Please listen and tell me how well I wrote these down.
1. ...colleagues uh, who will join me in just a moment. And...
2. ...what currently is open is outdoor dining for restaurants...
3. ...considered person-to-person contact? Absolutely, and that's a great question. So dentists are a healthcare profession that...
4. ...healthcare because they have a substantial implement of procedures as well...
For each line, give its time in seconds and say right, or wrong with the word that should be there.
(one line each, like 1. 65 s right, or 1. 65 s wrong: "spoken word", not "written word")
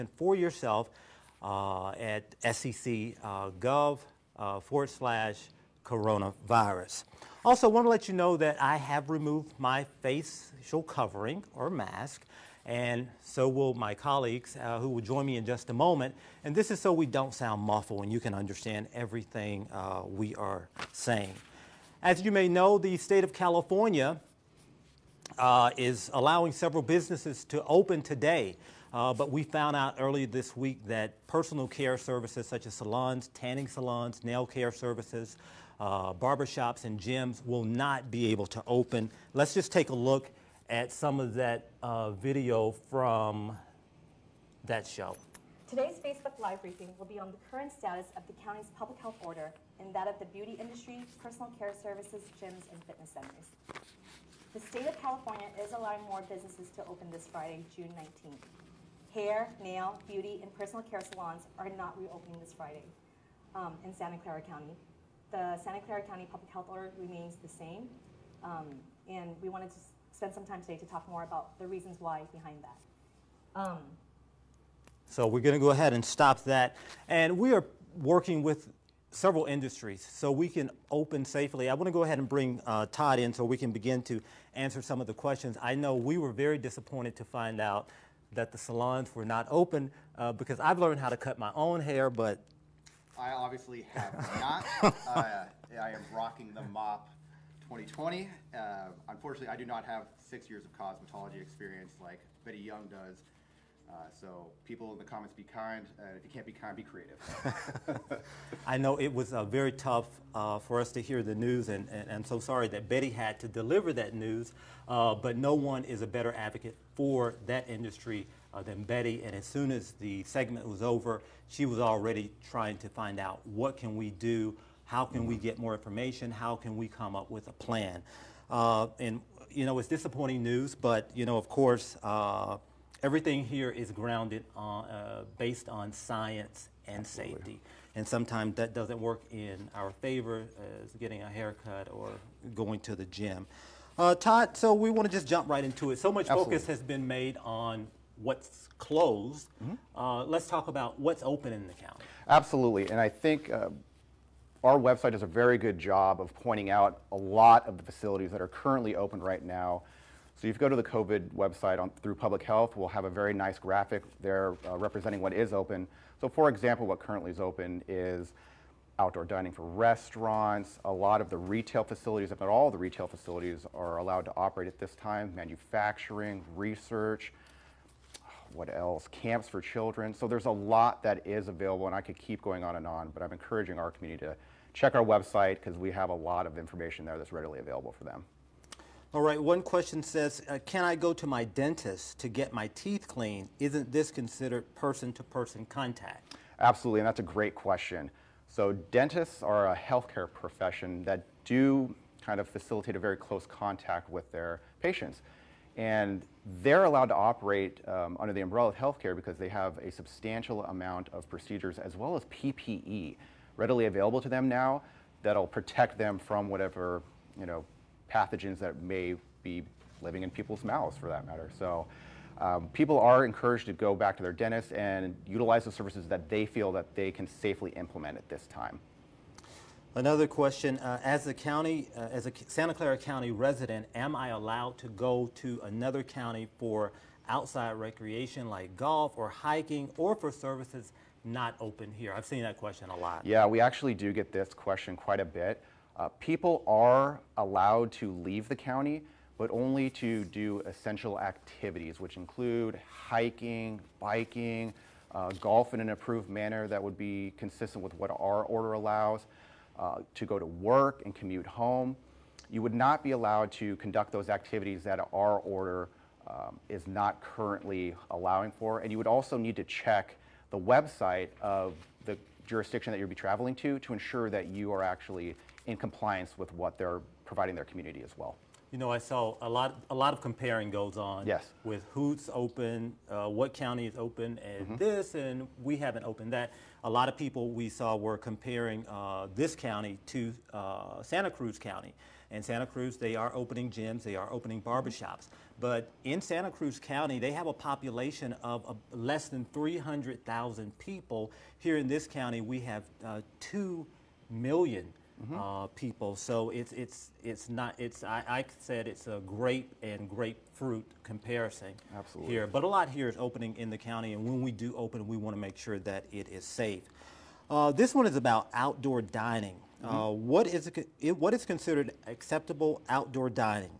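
1. 13 s right
2. 166 s right
3. 194 s right
4. 208 s wrong: "amount", not "implement".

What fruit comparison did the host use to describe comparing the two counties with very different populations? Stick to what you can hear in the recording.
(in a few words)
grape and grapefruit.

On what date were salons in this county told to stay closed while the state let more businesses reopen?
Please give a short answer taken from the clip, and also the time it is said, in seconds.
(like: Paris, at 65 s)
June 19th, at 57 s.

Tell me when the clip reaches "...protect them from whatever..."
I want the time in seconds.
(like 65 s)
215 s.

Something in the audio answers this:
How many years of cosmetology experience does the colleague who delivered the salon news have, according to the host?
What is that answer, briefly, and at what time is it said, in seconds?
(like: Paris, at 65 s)
6, at 100 s.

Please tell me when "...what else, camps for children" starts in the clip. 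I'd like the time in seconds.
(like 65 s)
178 s.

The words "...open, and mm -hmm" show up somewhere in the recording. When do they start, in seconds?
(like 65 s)
283 s.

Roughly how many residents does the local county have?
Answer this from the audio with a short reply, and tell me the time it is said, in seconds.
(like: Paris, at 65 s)
2 million, at 303 s.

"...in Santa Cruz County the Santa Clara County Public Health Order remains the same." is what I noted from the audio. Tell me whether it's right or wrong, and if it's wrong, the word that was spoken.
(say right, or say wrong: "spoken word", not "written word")
wrong: "Clara", not "Cruz".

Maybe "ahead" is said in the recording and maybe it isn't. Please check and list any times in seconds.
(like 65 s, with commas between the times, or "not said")
75 s, 82 s.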